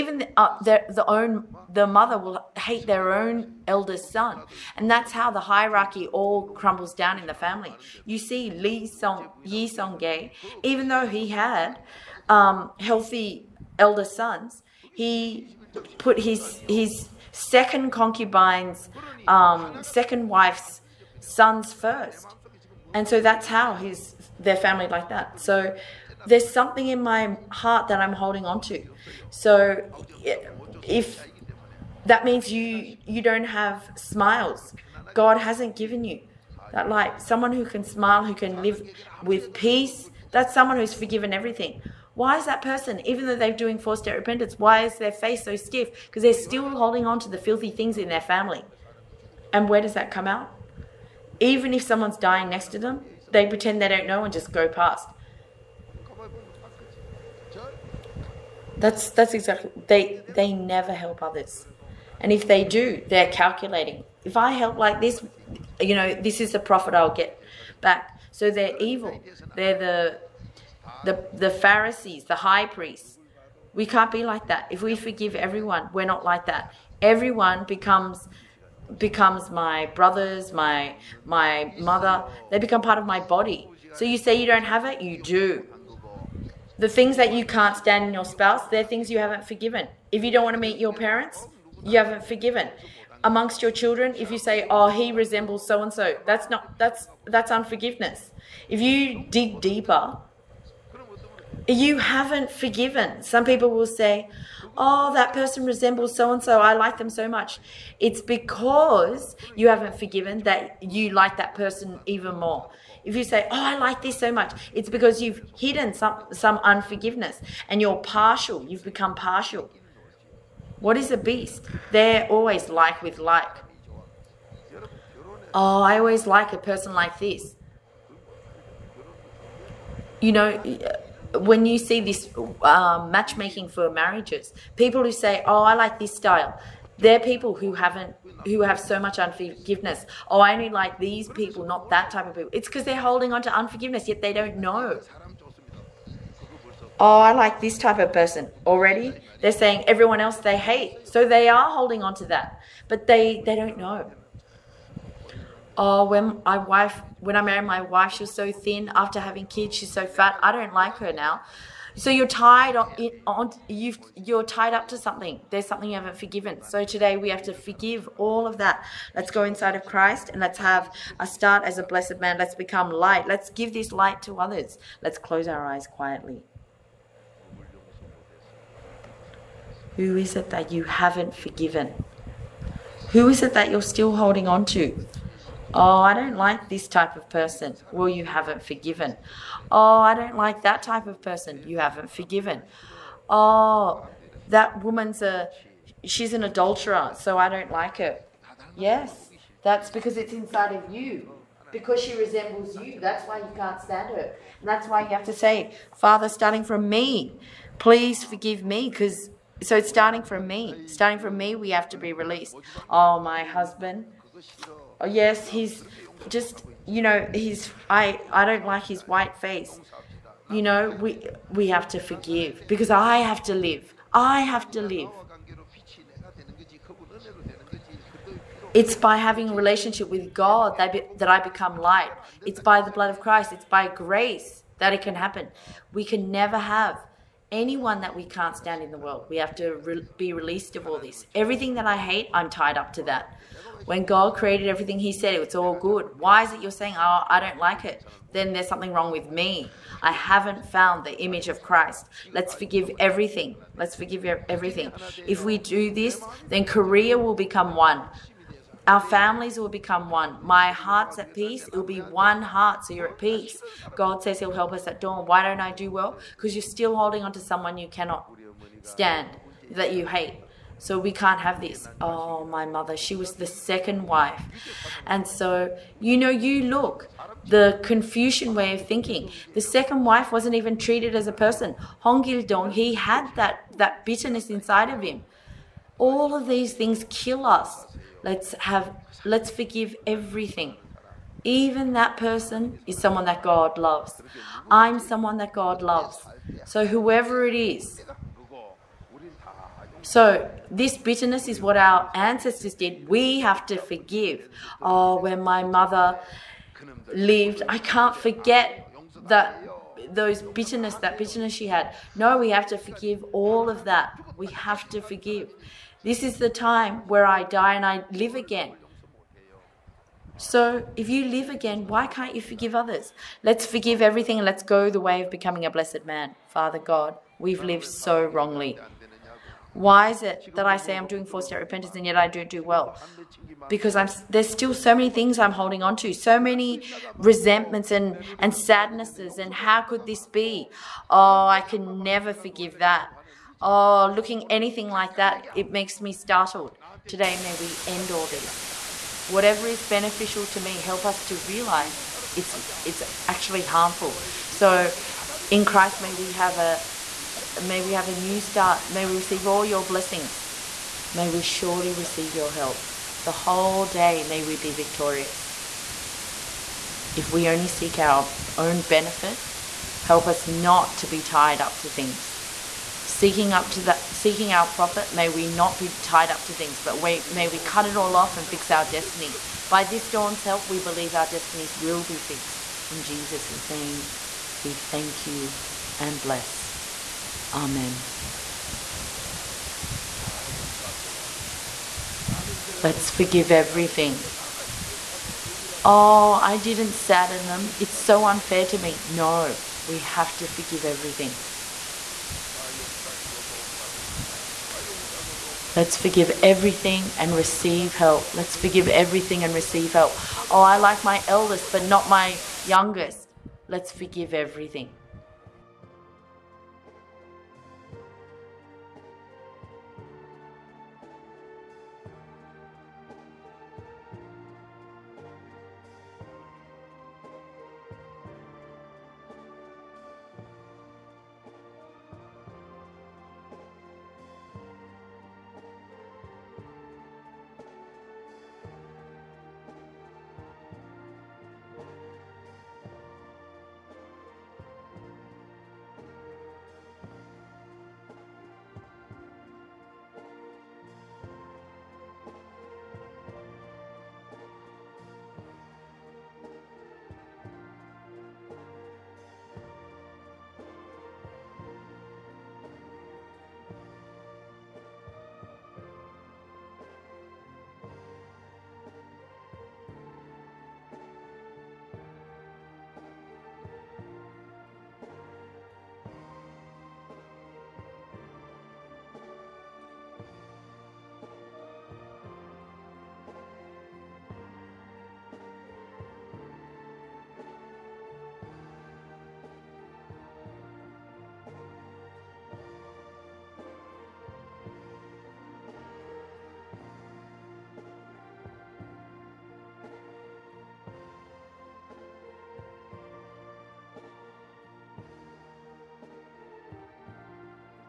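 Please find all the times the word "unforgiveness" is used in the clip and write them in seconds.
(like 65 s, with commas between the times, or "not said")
97 s, 116 s, 139 s, 143 s.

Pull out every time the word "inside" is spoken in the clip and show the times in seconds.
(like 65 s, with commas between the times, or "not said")
169 s, 200 s, 284 s.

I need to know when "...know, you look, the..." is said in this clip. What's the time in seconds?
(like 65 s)
276 s.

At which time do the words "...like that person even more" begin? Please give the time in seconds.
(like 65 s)
111 s.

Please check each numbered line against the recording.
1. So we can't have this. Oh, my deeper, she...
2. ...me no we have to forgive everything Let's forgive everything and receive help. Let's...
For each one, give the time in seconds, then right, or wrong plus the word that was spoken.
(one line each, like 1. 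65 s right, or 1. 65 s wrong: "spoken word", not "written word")
1. 270 s wrong: "mother", not "deeper"
2. 398 s right.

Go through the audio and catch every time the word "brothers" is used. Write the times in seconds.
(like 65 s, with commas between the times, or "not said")
79 s.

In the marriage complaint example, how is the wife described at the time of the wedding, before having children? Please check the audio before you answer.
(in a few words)
Thin.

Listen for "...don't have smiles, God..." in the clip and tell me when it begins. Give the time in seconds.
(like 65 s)
33 s.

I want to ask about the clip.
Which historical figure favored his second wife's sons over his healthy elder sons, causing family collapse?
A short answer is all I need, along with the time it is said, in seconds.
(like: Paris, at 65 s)
Lee Song Yi Song Gay, at 8 s.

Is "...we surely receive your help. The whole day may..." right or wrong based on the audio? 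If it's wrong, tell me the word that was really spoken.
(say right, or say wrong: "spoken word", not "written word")
right.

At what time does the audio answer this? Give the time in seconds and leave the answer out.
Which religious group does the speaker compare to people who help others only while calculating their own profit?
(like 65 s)
71 s.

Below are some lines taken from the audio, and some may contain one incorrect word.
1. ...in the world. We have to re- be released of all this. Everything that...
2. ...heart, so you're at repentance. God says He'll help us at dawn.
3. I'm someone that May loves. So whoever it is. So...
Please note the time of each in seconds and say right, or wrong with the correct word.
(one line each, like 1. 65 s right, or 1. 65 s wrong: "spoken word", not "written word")
1. 238 s right
2. 262 s wrong: "peace", not "repentance"
3. 294 s wrong: "God", not "May".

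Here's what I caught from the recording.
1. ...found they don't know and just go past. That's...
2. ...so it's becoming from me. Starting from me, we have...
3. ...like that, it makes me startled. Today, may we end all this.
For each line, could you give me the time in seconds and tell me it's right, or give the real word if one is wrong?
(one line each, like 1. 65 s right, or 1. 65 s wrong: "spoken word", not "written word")
1. 53 s wrong: "pretend", not "found"
2. 209 s wrong: "starting", not "becoming"
3. 344 s right.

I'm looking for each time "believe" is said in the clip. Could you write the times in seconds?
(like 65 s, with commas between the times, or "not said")
380 s.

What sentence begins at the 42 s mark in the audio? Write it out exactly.
Why is that person, even though they're doing forced repentance, why is their face so stiff?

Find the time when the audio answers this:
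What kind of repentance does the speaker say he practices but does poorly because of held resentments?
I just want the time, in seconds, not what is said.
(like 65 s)
331 s.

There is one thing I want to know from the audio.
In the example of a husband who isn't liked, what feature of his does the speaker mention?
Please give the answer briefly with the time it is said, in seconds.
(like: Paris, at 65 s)
His white face, at 218 s.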